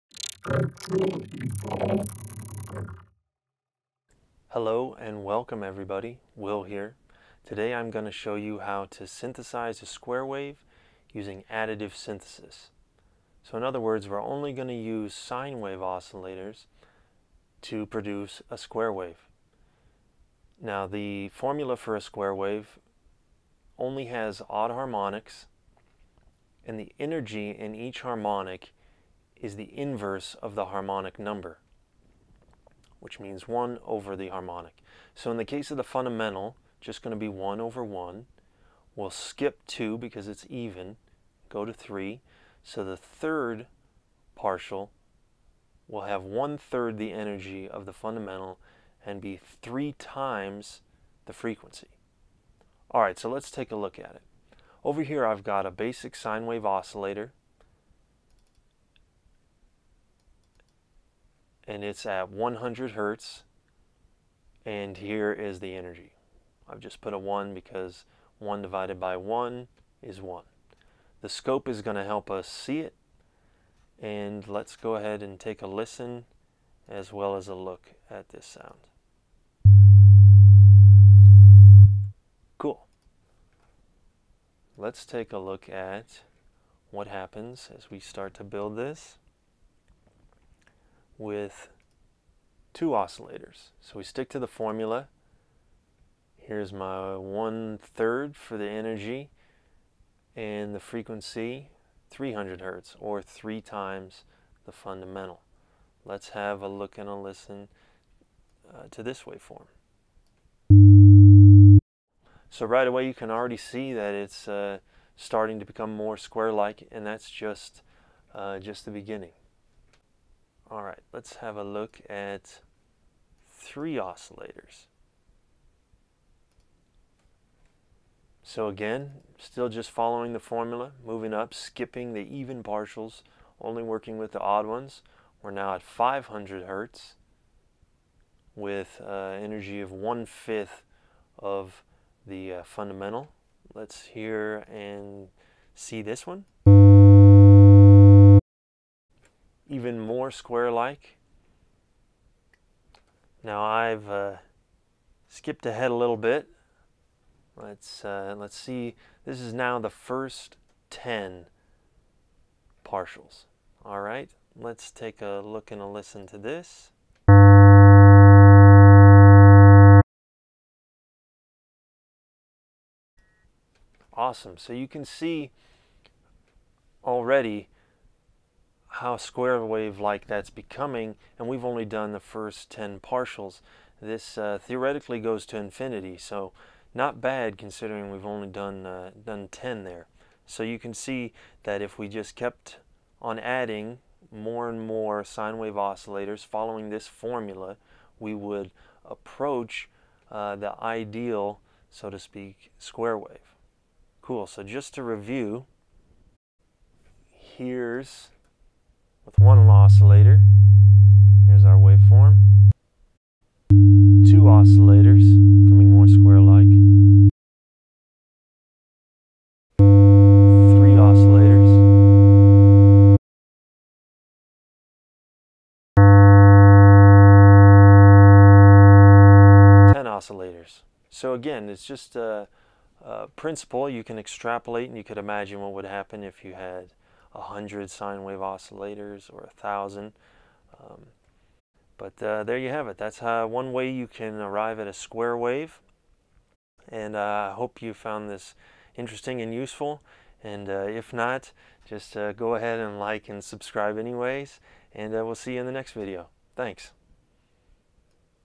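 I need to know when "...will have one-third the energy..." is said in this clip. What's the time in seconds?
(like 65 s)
45 s.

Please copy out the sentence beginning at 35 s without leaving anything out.
So in the case of the fundamental, just going to be 1 over 1.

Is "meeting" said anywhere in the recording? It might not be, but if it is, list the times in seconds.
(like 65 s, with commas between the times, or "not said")
not said.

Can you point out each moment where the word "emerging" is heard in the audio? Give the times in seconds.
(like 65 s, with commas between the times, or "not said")
not said.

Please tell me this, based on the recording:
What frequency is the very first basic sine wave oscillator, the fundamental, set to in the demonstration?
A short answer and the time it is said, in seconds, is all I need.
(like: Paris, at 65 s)
100 hertz, at 62 s.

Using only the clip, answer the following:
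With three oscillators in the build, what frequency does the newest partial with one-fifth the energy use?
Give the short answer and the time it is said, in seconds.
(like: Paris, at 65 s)
500 hertz, at 135 s.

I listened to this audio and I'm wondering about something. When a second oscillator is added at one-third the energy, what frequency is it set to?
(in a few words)
300 hertz.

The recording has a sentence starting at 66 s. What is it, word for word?
I've just put a 1 because 1 divided by 1 is 1.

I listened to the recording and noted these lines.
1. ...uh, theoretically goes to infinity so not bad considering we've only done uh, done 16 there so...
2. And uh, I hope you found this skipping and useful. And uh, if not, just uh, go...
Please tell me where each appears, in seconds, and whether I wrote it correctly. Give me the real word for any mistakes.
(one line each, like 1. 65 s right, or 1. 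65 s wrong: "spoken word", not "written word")
1. 184 s wrong: "10", not "16"
2. 246 s wrong: "interesting", not "skipping".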